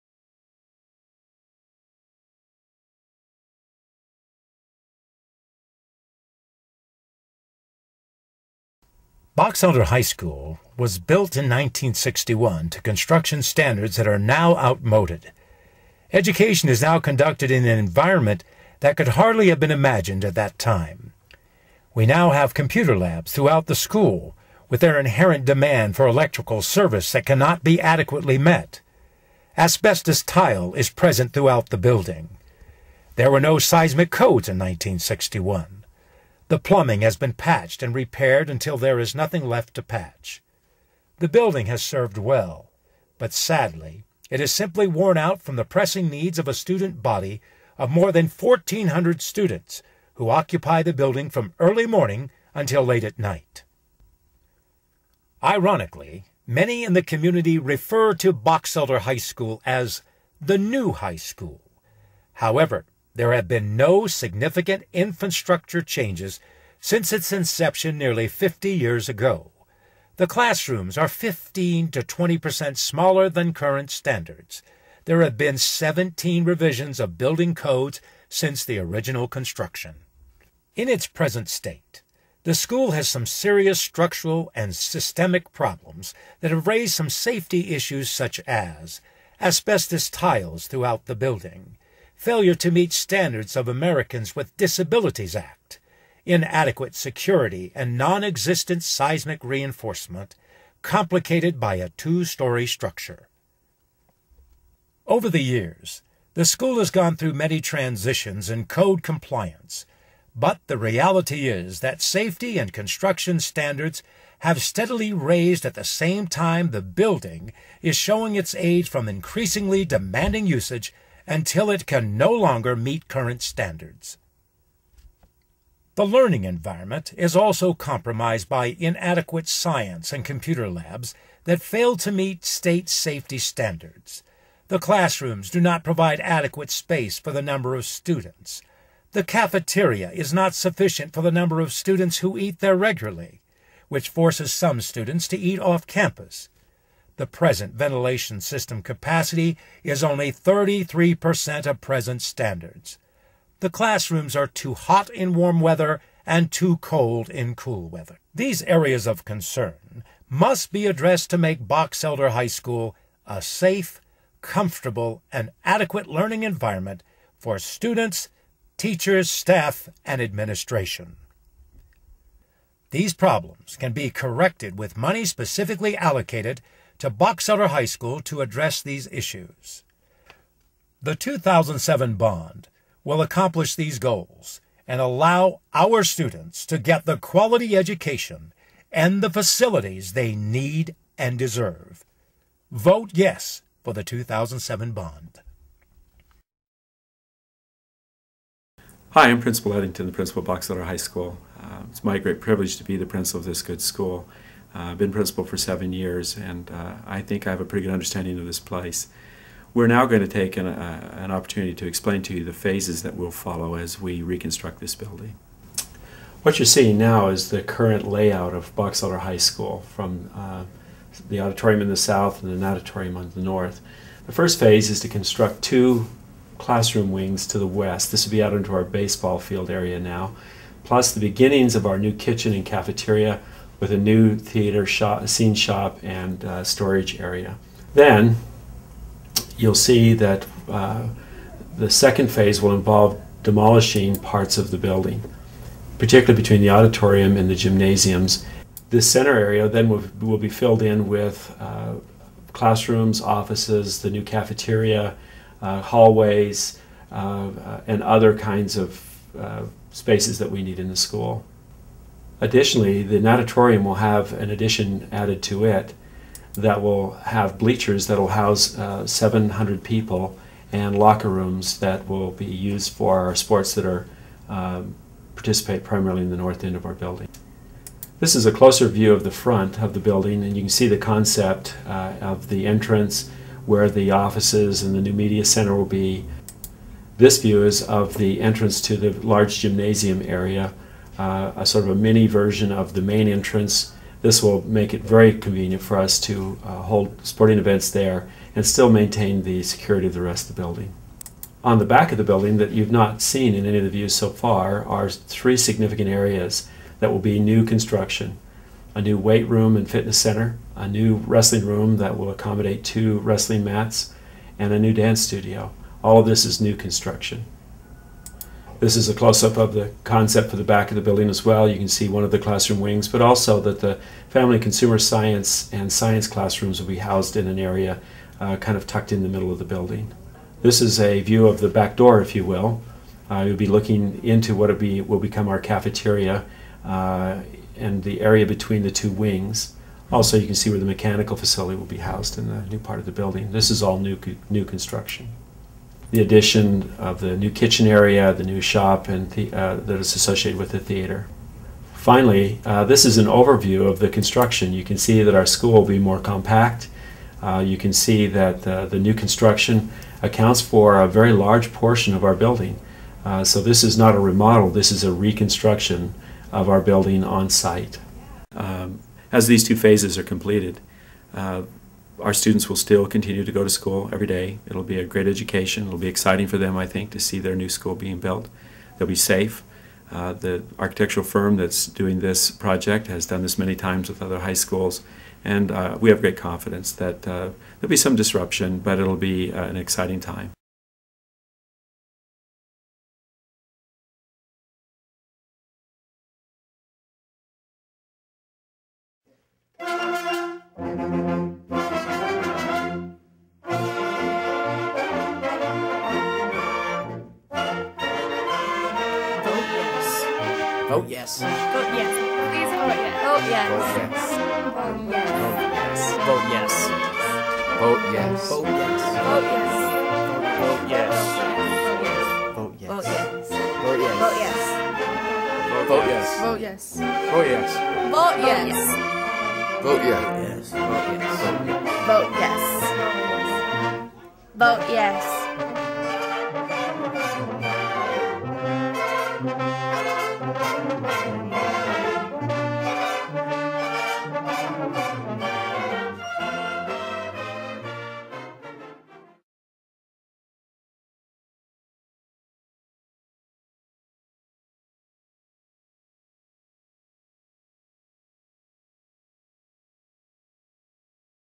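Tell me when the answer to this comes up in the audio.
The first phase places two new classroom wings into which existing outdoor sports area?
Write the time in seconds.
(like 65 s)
228 s.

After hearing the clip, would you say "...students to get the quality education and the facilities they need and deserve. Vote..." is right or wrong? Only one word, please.
right.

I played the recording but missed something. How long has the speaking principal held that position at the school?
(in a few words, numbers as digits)
seven years.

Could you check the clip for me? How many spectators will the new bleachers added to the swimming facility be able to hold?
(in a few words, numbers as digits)
700.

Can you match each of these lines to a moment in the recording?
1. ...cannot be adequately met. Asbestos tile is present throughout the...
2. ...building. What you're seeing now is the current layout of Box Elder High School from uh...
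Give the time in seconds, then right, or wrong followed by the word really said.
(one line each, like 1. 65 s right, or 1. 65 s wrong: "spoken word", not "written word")
1. 27 s right
2. 214 s right.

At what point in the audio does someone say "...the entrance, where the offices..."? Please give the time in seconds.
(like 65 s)
282 s.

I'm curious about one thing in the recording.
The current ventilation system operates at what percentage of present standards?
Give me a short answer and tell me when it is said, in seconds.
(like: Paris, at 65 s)
33%, at 150 s.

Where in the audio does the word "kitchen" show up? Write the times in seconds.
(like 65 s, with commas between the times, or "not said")
232 s, 347 s.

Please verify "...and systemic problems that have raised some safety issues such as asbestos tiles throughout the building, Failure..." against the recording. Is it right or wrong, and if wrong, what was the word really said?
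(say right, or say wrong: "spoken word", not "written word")
right.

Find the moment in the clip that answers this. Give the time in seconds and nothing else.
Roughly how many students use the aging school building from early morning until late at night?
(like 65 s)
47 s.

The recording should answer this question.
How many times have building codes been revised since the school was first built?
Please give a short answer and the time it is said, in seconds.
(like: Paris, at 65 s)
17, at 75 s.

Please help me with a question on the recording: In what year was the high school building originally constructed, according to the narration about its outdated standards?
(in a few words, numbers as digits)
1961.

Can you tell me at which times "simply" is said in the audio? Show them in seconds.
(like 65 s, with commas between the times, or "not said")
44 s.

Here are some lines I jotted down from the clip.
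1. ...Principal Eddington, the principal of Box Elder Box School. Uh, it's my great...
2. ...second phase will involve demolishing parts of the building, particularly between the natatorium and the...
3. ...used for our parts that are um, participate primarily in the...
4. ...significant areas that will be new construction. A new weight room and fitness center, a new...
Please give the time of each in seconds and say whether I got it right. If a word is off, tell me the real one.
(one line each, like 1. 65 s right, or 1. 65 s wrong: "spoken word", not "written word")
1. 199 s wrong: "High", not "Box"
2. 241 s wrong: "auditorium", not "natatorium"
3. 272 s wrong: "sports", not "parts"
4. 305 s right.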